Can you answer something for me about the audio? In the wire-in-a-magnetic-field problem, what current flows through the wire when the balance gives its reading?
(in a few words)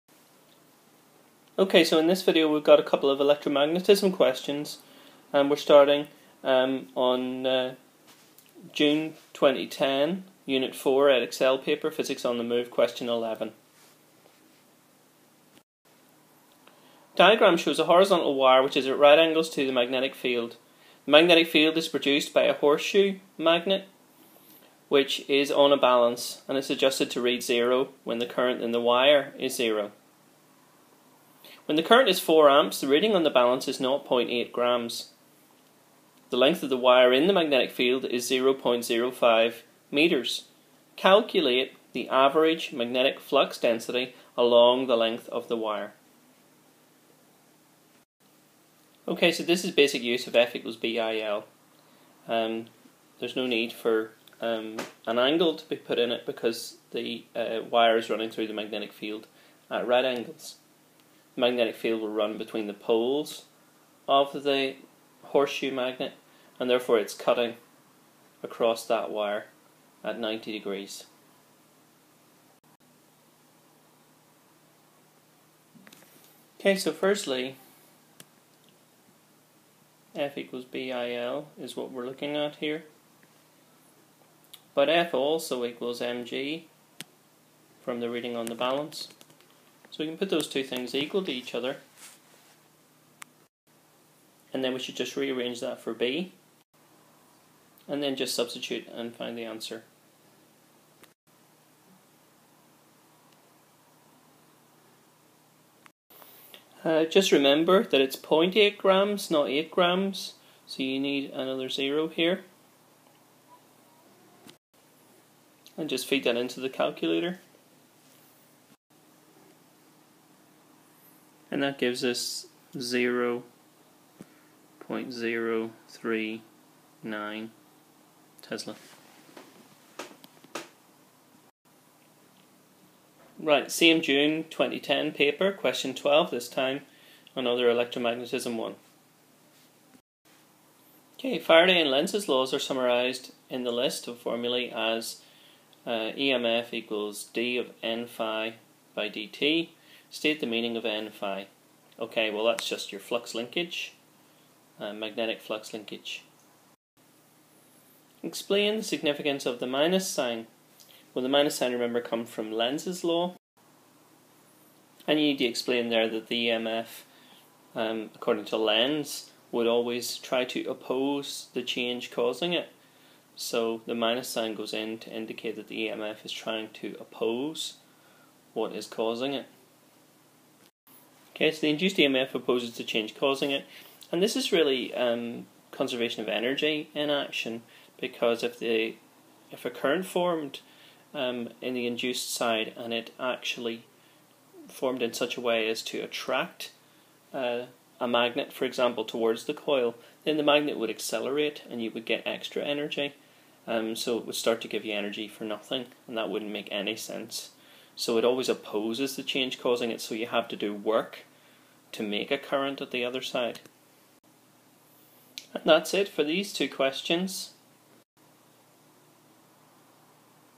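4 amps.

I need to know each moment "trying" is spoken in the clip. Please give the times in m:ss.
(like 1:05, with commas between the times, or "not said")
2:56.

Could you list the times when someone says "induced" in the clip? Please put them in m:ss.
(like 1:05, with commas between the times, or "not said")
3:01, 3:11.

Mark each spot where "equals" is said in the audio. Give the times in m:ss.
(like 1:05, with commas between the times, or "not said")
0:50, 1:20, 1:25, 1:30, 2:26.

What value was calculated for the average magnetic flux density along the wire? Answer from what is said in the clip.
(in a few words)
0.039 Tesla.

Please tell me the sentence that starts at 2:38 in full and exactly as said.
Explain the significance of the minus sign.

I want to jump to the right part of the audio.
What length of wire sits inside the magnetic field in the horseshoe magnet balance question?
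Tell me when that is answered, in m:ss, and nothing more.
0:38.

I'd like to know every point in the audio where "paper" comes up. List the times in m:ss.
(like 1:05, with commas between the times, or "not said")
0:11, 2:15.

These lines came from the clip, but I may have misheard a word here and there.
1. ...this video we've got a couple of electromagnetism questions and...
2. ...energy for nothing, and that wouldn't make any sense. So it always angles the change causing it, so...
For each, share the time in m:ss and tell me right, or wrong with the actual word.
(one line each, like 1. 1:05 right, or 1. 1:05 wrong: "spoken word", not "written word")
1. 0:02 right
2. 3:24 wrong: "opposes", not "angles".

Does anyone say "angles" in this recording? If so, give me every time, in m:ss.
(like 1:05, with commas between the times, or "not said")
0:19, 0:55, 1:00.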